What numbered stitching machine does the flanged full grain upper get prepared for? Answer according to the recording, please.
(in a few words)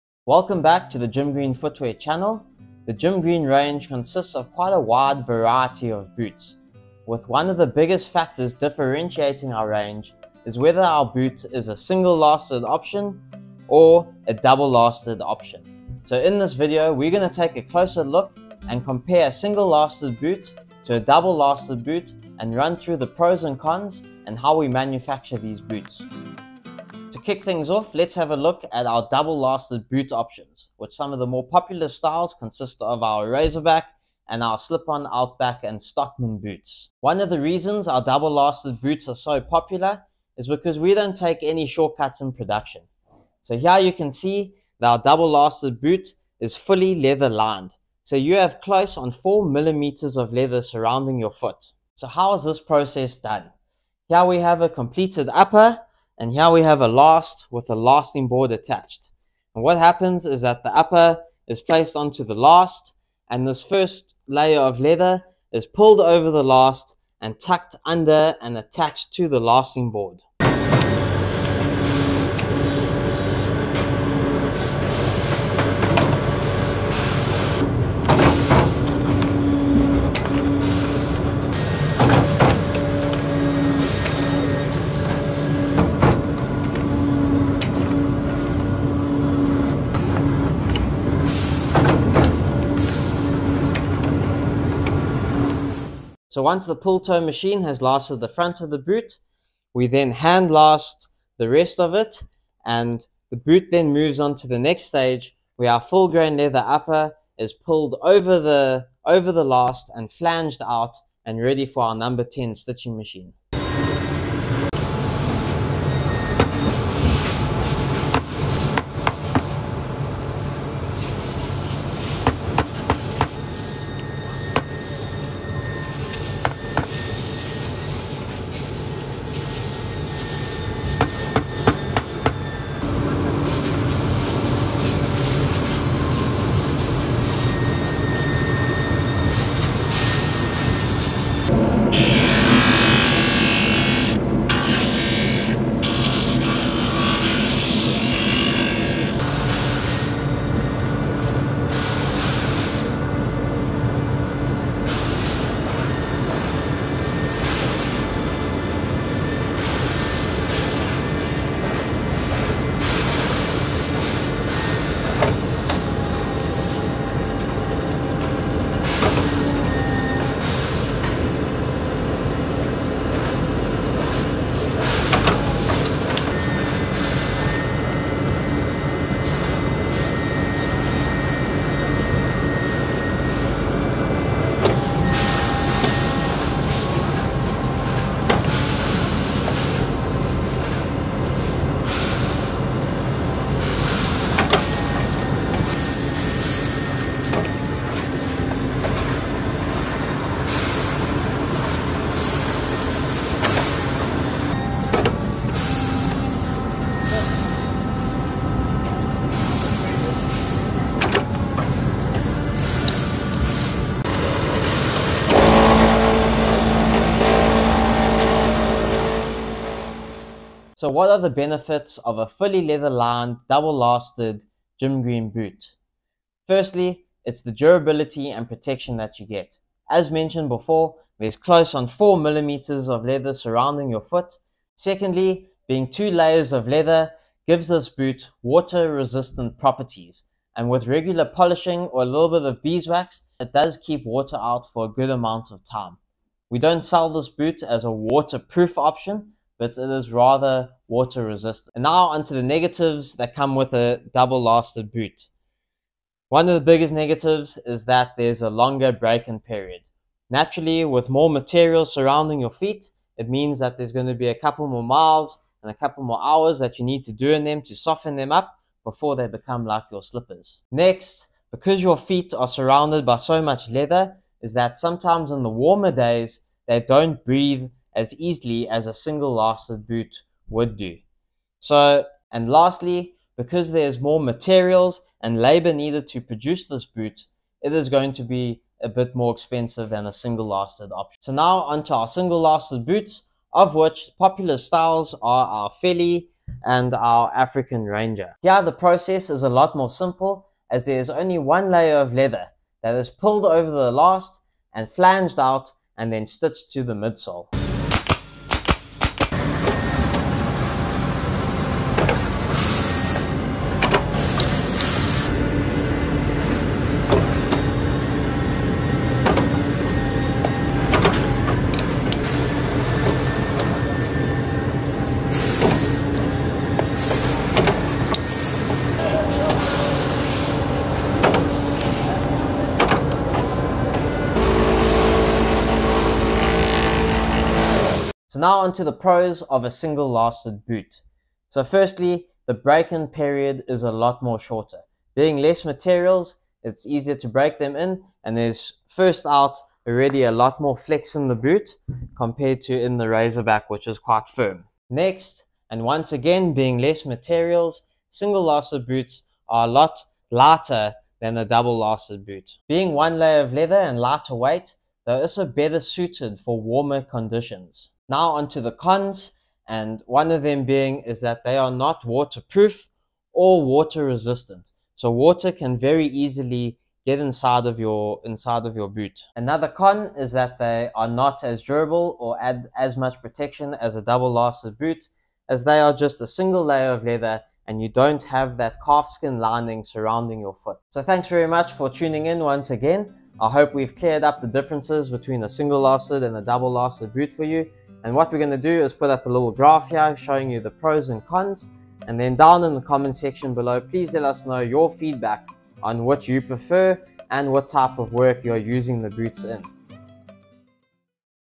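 number 10.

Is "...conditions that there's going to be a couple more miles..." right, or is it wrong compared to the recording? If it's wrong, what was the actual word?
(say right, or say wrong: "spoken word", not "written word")
wrong: "means", not "conditions".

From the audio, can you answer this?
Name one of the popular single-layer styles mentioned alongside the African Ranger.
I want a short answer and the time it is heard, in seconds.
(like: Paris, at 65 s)
Philly, at 295 s.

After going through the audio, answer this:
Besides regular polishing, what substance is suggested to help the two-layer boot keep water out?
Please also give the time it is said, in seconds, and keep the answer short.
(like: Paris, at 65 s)
beeswax, at 242 s.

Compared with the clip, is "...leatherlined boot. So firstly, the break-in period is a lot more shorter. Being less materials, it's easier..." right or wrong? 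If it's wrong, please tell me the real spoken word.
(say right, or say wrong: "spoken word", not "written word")
wrong: "lasted", not "leatherlined".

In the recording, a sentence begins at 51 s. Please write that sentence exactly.
So how is this process done?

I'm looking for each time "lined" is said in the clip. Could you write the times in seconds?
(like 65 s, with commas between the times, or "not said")
47 s, 222 s.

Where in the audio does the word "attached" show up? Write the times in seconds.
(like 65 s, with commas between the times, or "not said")
58 s, 68 s.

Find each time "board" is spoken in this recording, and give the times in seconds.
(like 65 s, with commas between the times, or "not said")
58 s, 69 s.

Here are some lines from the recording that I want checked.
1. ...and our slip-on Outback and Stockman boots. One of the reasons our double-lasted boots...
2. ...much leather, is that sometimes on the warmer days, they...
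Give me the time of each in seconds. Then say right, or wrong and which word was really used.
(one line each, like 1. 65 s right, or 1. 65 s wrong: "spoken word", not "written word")
1. 34 s right
2. 273 s right.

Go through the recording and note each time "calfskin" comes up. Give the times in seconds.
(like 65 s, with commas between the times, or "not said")
388 s.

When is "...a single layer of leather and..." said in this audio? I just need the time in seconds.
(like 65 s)
386 s.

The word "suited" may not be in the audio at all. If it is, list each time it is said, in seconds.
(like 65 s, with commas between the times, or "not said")
365 s.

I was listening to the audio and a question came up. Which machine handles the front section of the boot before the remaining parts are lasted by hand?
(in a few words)
pull toe machine.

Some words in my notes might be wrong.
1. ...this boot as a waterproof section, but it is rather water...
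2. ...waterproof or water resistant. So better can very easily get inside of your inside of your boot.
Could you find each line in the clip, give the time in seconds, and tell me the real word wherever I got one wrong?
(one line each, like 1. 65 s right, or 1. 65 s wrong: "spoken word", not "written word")
1. 247 s wrong: "option", not "section"
2. 372 s wrong: "water", not "better".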